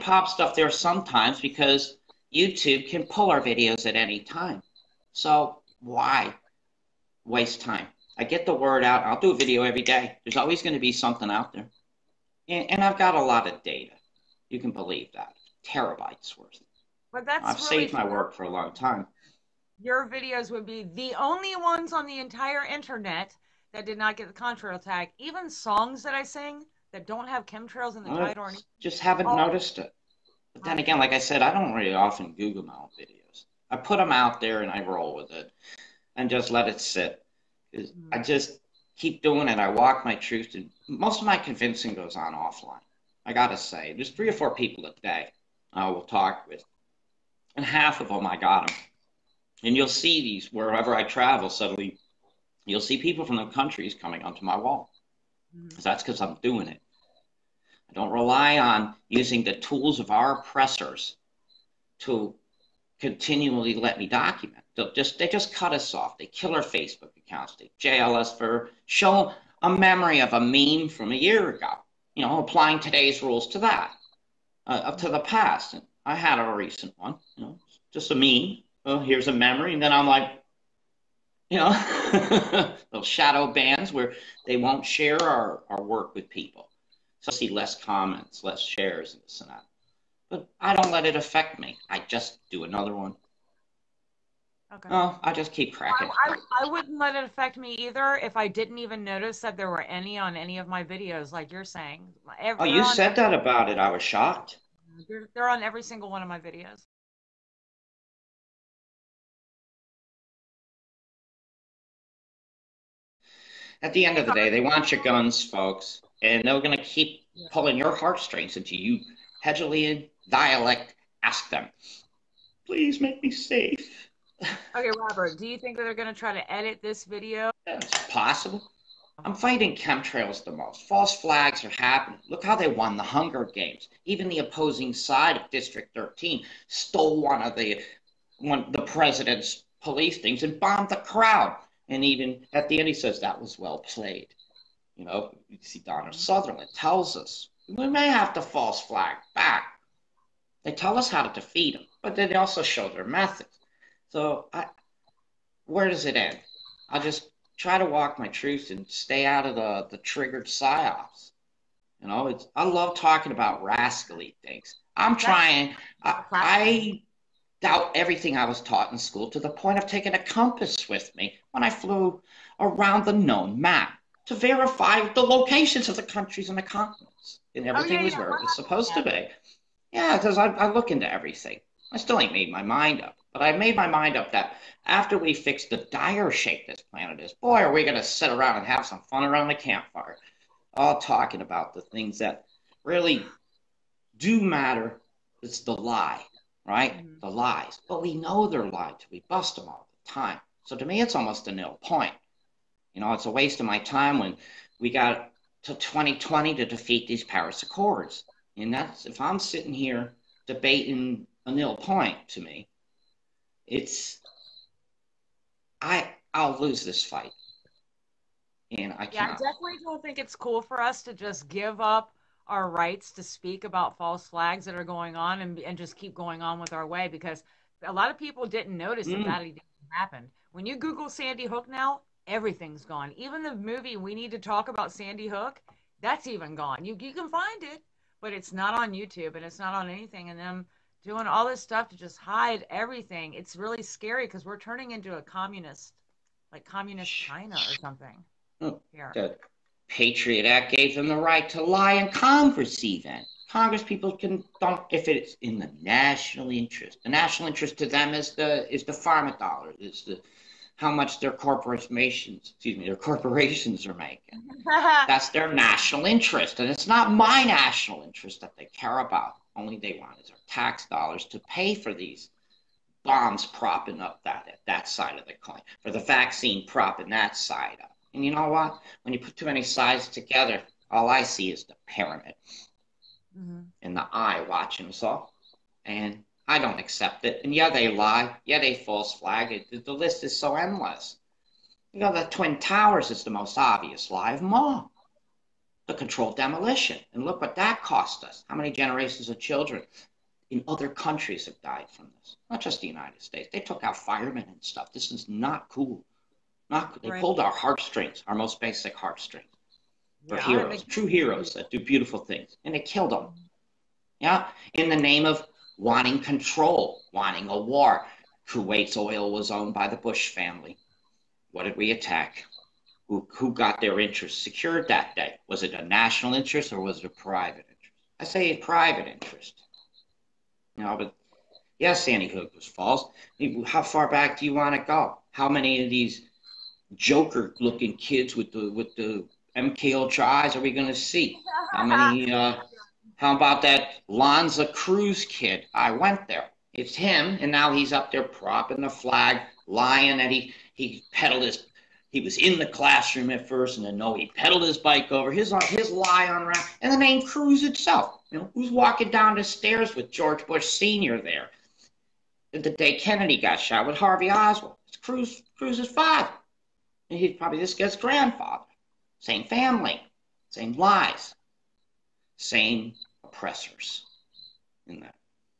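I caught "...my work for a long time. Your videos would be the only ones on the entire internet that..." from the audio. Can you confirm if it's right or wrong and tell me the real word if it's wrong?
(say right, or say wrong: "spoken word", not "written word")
right.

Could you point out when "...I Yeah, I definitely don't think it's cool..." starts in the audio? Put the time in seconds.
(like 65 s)
218 s.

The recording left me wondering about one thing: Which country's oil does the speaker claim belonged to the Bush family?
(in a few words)
Kuwait.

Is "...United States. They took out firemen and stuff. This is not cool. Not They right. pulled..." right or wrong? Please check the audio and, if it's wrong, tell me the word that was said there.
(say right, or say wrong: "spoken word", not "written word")
right.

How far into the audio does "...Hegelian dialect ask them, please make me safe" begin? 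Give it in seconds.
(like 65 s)
119 s.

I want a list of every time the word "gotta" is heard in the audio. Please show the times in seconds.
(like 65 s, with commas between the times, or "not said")
43 s.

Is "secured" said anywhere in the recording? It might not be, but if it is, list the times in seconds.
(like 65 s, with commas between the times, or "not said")
324 s.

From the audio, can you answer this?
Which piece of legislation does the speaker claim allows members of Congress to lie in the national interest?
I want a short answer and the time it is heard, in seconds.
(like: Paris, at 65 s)
The Patriot Act, at 249 s.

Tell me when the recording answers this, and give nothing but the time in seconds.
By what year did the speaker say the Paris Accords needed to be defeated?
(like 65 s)
205 s.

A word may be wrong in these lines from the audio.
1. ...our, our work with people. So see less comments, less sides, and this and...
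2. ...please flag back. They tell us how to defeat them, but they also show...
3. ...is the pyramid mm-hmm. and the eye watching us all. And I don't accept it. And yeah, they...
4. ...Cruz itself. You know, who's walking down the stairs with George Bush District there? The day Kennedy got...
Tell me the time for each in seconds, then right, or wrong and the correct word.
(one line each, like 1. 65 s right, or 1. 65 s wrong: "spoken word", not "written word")
1. 85 s wrong: "shares", not "sides"
2. 148 s wrong: "false", not "please"
3. 281 s right
4. 357 s wrong: "Senior", not "District".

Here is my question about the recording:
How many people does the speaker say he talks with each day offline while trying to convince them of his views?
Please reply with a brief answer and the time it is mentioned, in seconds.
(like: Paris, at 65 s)
3 or 4, at 44 s.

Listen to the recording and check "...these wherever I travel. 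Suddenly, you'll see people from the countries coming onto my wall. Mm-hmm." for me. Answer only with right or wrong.
right.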